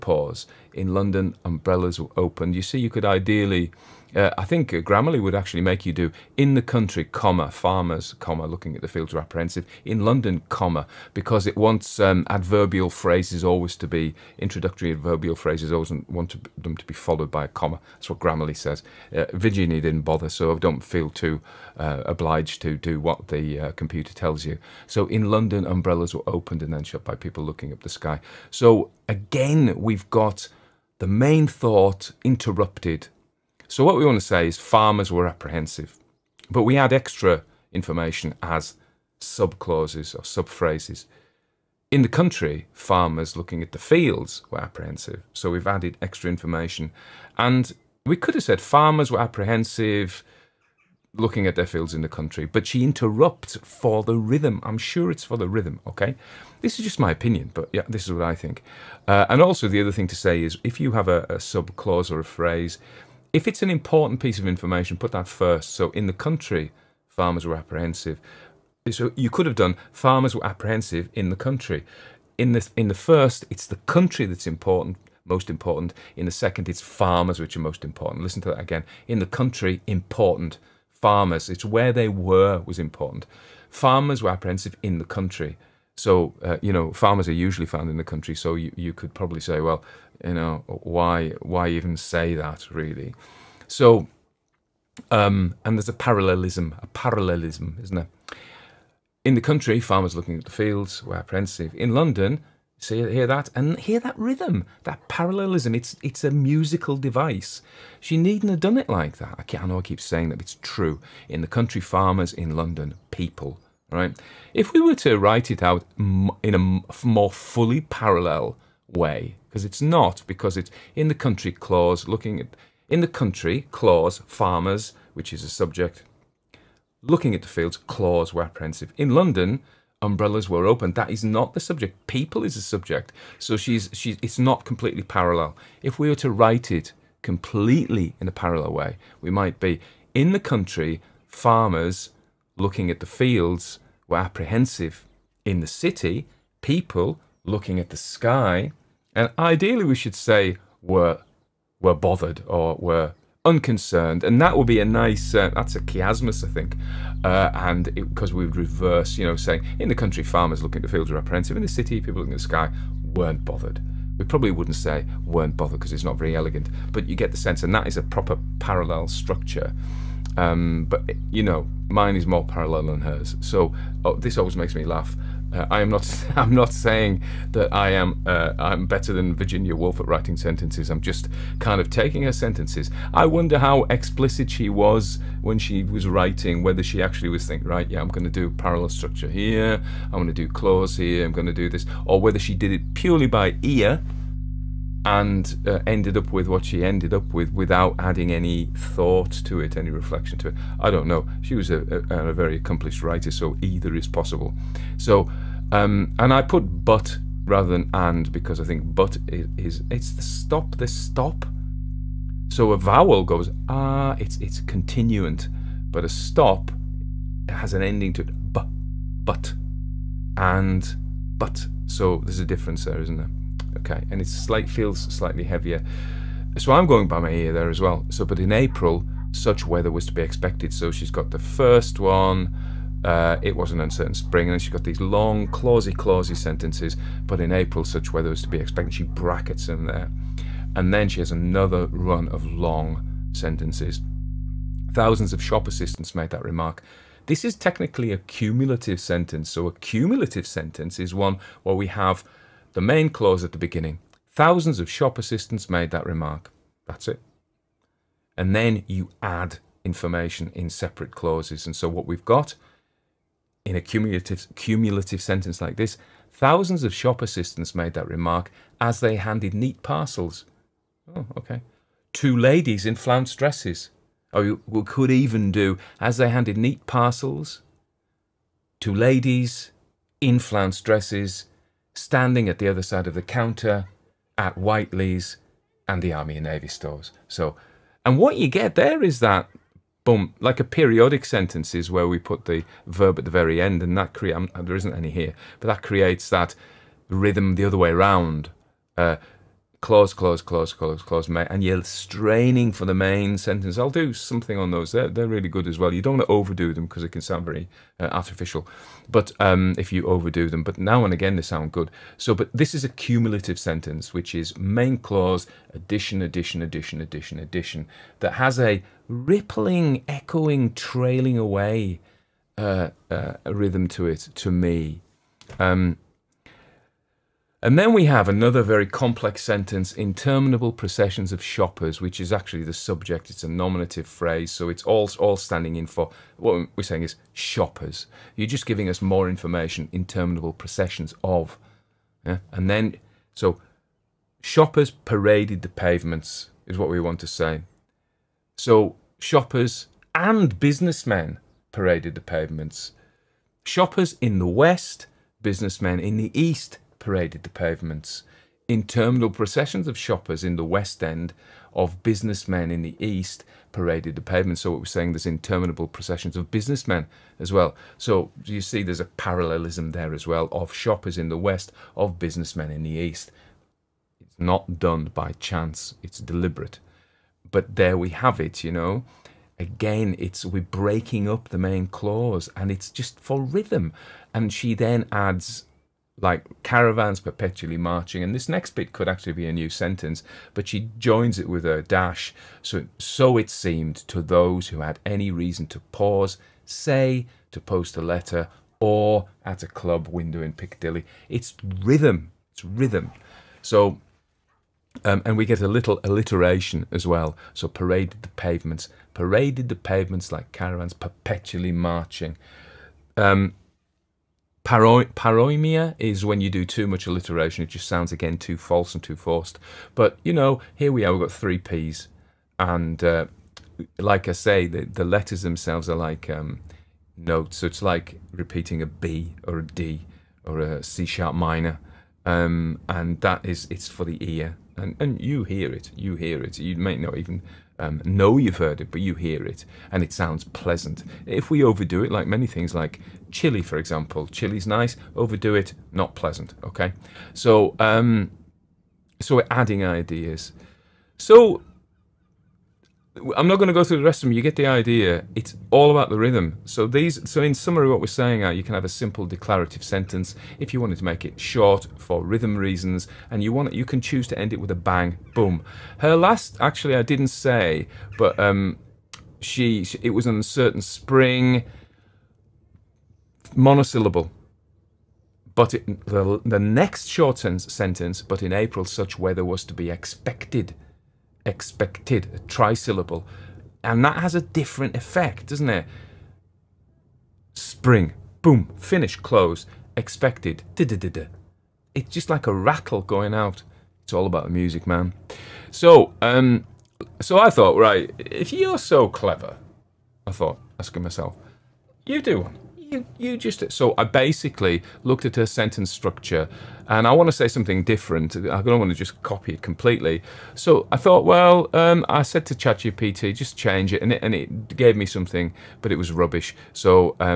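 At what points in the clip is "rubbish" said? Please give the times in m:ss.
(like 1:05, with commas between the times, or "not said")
8:36.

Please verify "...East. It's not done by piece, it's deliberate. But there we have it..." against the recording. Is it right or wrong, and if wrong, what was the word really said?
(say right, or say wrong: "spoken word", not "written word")
wrong: "chance", not "piece".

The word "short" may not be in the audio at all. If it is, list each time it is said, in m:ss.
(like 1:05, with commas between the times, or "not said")
7:41, 7:57.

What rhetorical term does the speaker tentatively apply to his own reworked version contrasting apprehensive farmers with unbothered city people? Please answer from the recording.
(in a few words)
chiasmus.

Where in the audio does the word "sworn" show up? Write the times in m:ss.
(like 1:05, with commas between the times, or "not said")
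not said.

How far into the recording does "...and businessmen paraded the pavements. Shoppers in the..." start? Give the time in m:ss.
5:50.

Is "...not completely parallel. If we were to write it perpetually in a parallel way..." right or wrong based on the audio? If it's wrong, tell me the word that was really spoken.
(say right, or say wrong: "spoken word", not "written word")
wrong: "completely", not "perpetually".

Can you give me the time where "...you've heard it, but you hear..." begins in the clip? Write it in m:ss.
7:18.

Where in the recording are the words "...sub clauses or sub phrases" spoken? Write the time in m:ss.
0:39.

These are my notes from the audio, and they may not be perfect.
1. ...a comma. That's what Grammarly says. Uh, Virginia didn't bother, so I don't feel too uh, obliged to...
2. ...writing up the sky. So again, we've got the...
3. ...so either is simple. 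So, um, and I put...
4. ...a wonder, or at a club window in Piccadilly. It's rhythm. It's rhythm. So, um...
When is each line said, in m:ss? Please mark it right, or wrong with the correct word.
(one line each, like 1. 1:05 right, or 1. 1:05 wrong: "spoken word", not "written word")
1. 0:17 right
2. 0:27 wrong: "looking", not "writing"
3. 3:23 wrong: "possible", not "simple"
4. 6:37 wrong: "letter", not "wonder".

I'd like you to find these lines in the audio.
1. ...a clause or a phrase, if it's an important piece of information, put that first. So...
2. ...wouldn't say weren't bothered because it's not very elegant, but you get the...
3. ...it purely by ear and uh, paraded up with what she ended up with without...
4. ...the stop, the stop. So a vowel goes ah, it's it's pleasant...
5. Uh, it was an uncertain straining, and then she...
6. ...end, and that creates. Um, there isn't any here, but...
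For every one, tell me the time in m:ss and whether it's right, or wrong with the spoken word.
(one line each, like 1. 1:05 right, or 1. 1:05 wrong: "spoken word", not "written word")
1. 1:01 right
2. 2:44 right
3. 3:12 wrong: "ended", not "paraded"
4. 3:30 wrong: "continuant", not "pleasant"
5. 3:53 wrong: "spring", not "straining"
6. 4:53 right.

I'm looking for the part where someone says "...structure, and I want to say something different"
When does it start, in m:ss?
8:25.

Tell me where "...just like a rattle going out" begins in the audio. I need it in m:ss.
8:12.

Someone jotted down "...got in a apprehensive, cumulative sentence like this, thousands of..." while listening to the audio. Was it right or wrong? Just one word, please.
wrong.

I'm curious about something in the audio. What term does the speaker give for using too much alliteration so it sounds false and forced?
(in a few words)
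paroimia.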